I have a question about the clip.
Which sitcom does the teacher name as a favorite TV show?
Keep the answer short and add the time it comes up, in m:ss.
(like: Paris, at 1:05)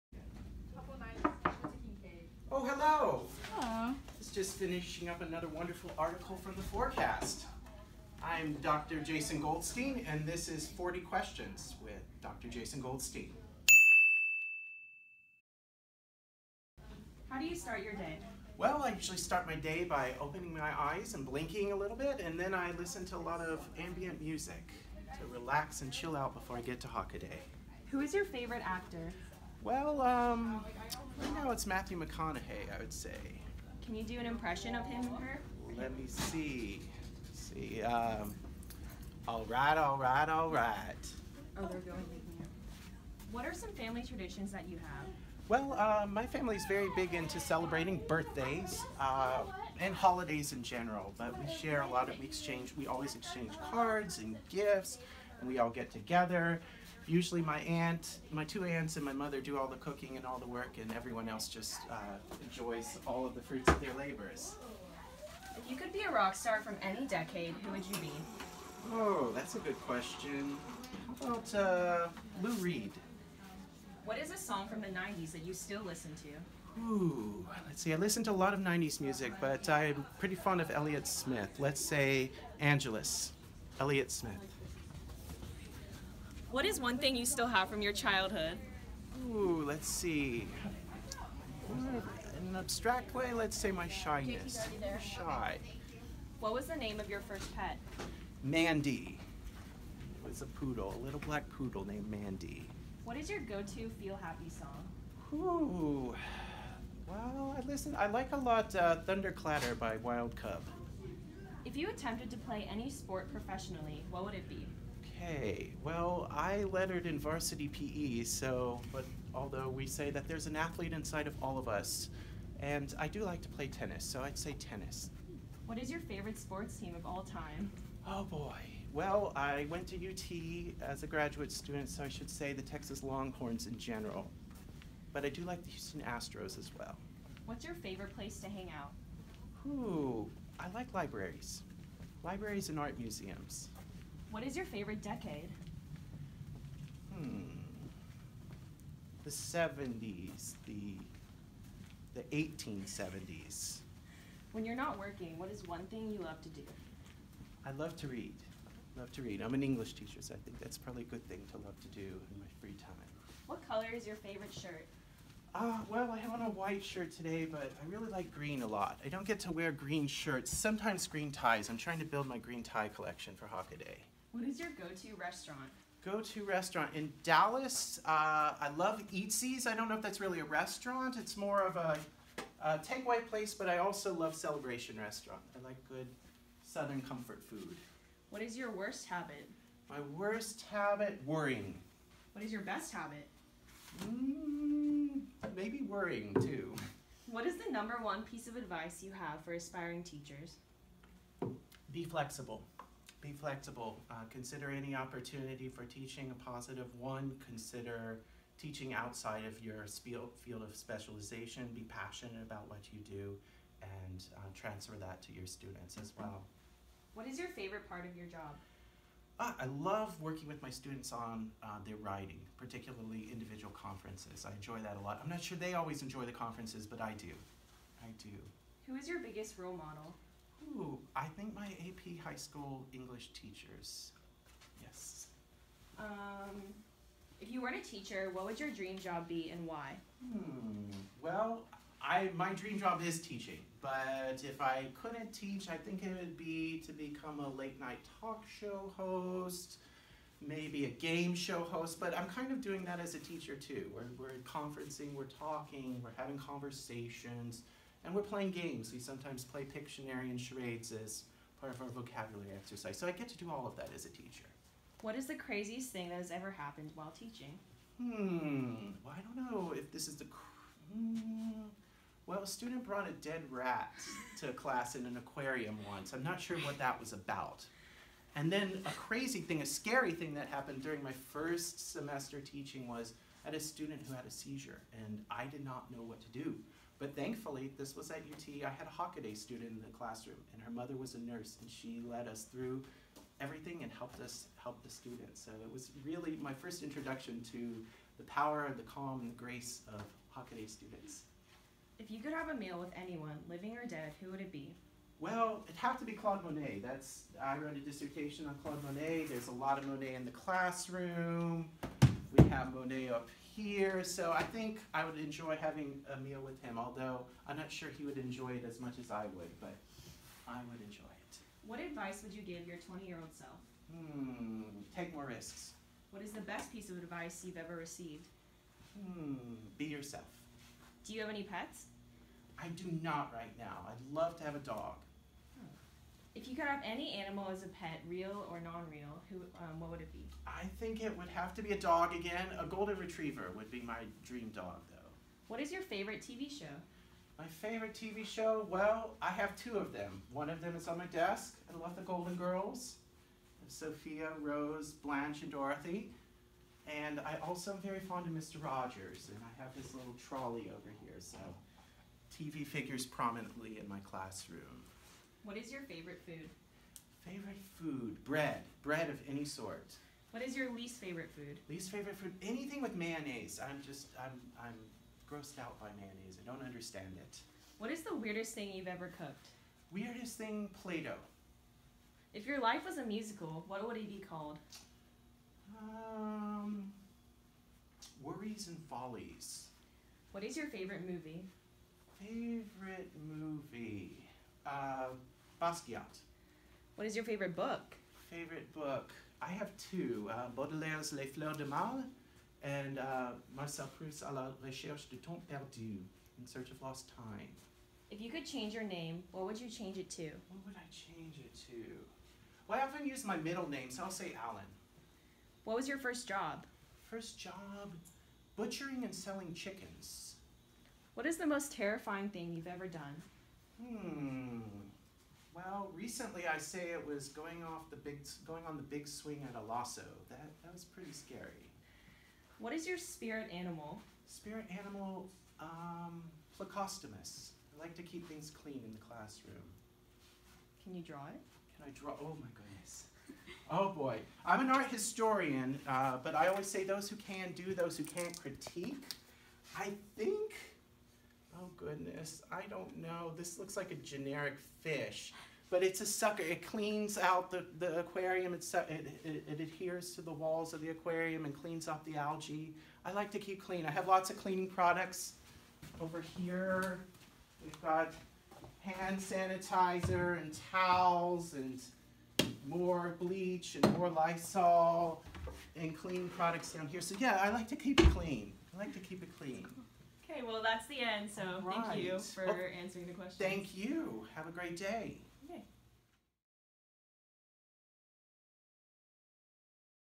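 The Golden Girls, at 5:51.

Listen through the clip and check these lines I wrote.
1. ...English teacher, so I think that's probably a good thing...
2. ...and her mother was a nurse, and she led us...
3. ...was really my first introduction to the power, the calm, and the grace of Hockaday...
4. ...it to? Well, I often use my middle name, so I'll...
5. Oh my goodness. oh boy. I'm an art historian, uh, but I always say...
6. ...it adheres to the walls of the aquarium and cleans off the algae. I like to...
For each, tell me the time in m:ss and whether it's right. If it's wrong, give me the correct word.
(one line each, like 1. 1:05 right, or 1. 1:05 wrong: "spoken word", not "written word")
1. 2:39 right
2. 4:50 right
3. 4:55 right
4. 6:51 right
5. 7:22 right
6. 7:39 right.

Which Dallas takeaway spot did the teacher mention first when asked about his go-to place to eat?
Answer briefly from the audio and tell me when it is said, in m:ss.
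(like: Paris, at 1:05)
Eatzi's, at 2:59.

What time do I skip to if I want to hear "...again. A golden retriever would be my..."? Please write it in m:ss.
5:42.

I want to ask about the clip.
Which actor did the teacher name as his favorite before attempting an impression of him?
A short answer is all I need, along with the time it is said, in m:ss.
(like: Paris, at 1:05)
Matthew McConaughey, at 0:31.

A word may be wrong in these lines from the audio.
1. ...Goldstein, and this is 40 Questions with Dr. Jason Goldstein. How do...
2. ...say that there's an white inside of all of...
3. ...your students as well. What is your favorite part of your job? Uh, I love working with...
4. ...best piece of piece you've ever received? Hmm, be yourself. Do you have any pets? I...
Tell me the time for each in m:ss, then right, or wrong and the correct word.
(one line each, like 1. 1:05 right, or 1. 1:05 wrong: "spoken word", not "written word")
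1. 0:09 right
2. 1:59 wrong: "athlete", not "white"
3. 3:35 right
4. 5:26 wrong: "advice", not "piece".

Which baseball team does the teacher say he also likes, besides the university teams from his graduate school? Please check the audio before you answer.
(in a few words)
Houston Astros.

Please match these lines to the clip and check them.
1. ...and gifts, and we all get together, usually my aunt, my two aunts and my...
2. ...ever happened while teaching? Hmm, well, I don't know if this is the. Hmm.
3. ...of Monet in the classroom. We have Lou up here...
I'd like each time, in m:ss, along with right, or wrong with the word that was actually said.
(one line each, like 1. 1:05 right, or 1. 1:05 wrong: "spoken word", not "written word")
1. 0:54 right
2. 4:26 right
3. 5:09 wrong: "Monet", not "Lou".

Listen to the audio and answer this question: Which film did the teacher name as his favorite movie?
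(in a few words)
Basquiat.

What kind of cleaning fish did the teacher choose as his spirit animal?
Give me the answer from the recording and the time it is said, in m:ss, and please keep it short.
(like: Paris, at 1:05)
Plecostomus, at 7:16.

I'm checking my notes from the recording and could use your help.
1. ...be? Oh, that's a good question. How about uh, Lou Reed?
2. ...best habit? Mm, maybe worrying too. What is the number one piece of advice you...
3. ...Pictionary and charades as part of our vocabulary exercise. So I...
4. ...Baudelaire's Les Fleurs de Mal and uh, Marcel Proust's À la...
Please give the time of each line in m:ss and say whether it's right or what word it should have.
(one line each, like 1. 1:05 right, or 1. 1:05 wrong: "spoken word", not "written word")
1. 1:07 right
2. 3:12 right
3. 4:19 right
4. 6:40 right.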